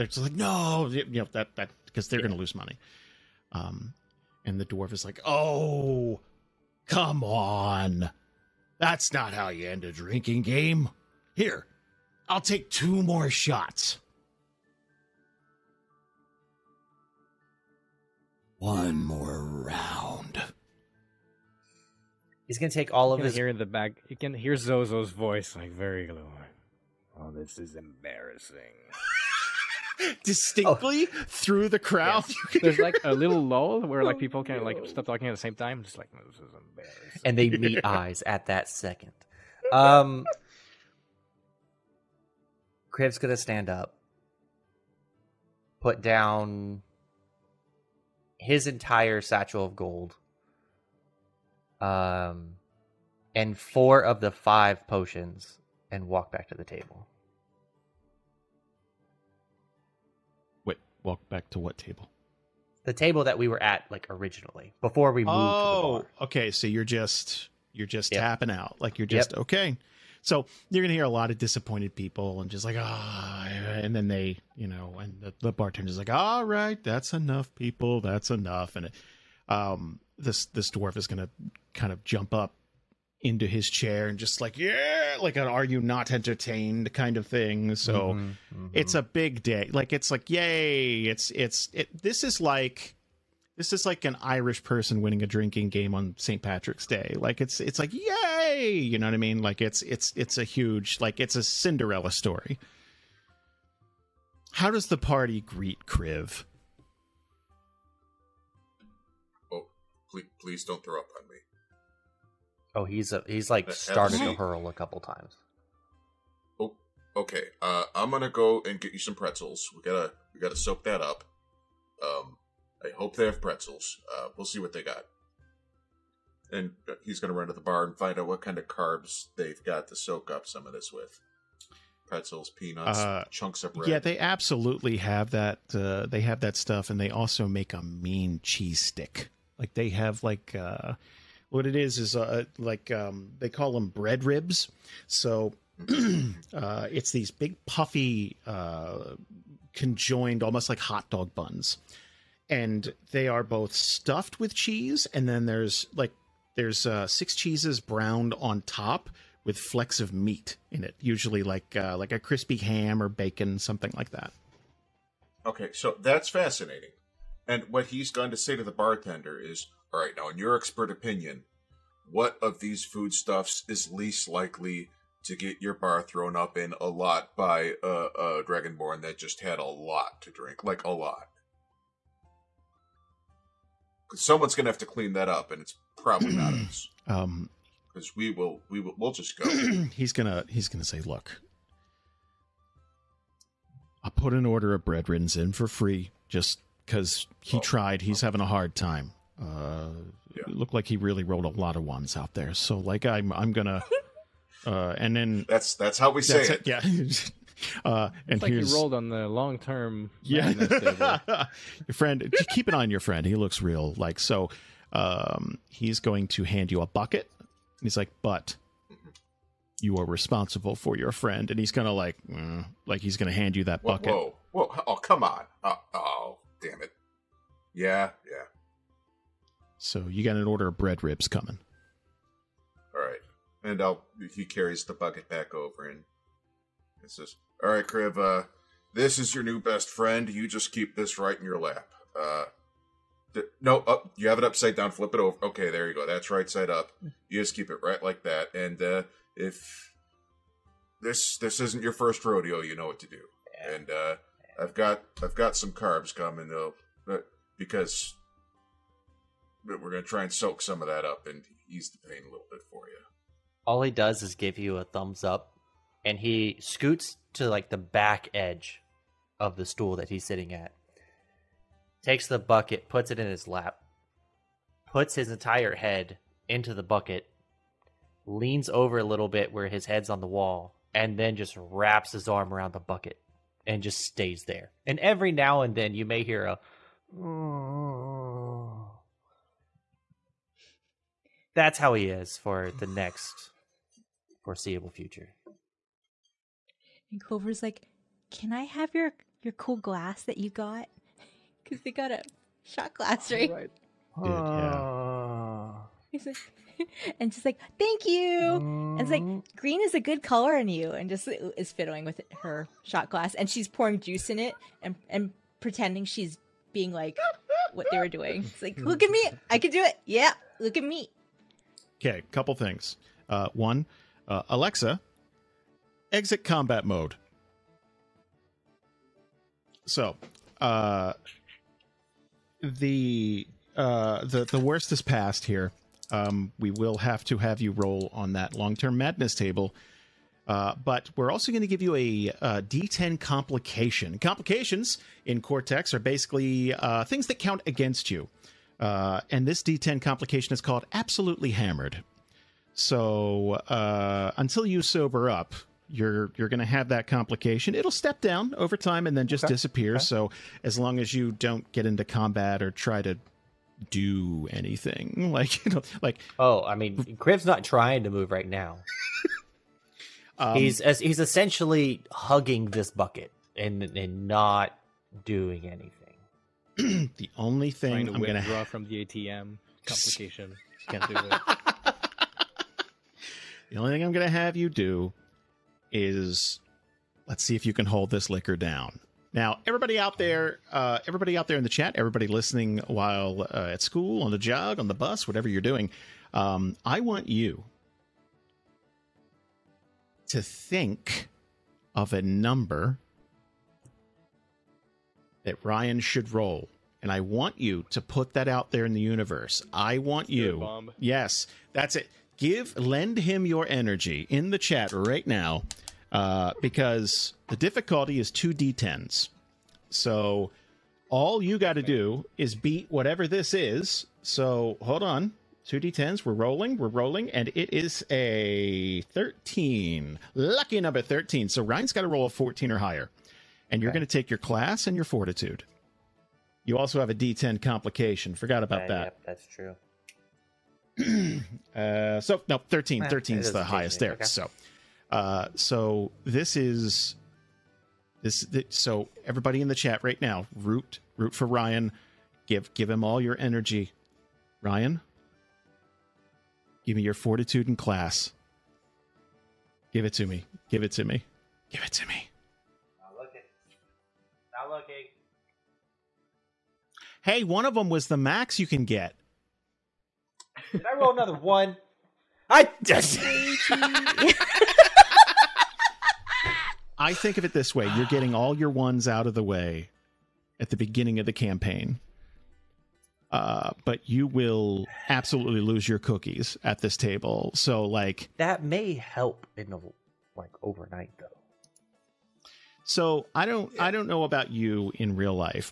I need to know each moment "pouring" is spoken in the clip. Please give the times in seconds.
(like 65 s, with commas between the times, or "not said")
313 s.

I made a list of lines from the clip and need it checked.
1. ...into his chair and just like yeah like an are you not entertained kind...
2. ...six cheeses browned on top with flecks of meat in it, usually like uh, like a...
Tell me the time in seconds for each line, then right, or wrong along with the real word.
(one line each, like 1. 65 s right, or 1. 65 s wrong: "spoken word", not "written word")
1. 83 s right
2. 157 s right.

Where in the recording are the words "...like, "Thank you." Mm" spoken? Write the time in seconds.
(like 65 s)
307 s.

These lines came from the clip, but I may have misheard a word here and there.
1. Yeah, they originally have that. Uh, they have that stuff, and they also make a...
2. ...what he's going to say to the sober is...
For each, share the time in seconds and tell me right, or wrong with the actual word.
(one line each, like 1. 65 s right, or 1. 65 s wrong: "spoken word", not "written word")
1. 133 s wrong: "absolutely", not "originally"
2. 167 s wrong: "bartender", not "sober".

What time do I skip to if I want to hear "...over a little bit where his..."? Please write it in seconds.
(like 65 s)
278 s.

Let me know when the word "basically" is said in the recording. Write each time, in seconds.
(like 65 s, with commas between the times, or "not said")
345 s.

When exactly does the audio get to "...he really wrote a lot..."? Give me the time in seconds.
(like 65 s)
200 s.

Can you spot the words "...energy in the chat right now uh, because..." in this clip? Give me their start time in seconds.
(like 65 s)
413 s.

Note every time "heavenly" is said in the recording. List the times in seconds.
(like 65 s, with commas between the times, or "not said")
not said.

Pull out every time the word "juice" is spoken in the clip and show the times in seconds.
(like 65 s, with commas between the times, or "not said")
314 s.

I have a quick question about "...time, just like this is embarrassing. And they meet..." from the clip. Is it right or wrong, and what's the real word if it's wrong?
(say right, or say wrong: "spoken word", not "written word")
right.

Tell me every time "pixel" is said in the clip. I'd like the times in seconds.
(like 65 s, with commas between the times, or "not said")
not said.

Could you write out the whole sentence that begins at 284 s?
And every now and then you may hear a that's how he is for the next foreseeable future.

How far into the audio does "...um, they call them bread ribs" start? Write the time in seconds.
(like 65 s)
142 s.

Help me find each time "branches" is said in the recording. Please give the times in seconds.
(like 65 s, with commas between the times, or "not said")
not said.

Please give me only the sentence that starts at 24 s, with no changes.
You can hear Zozo's voice, like very low.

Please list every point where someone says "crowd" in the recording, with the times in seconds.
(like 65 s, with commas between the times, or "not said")
31 s.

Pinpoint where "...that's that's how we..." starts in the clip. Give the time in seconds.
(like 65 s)
205 s.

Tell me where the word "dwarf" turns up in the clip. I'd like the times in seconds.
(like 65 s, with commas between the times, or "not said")
4 s, 80 s.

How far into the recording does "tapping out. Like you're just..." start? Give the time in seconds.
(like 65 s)
68 s.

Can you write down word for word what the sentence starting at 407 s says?
And I want you to put that out there in the universe.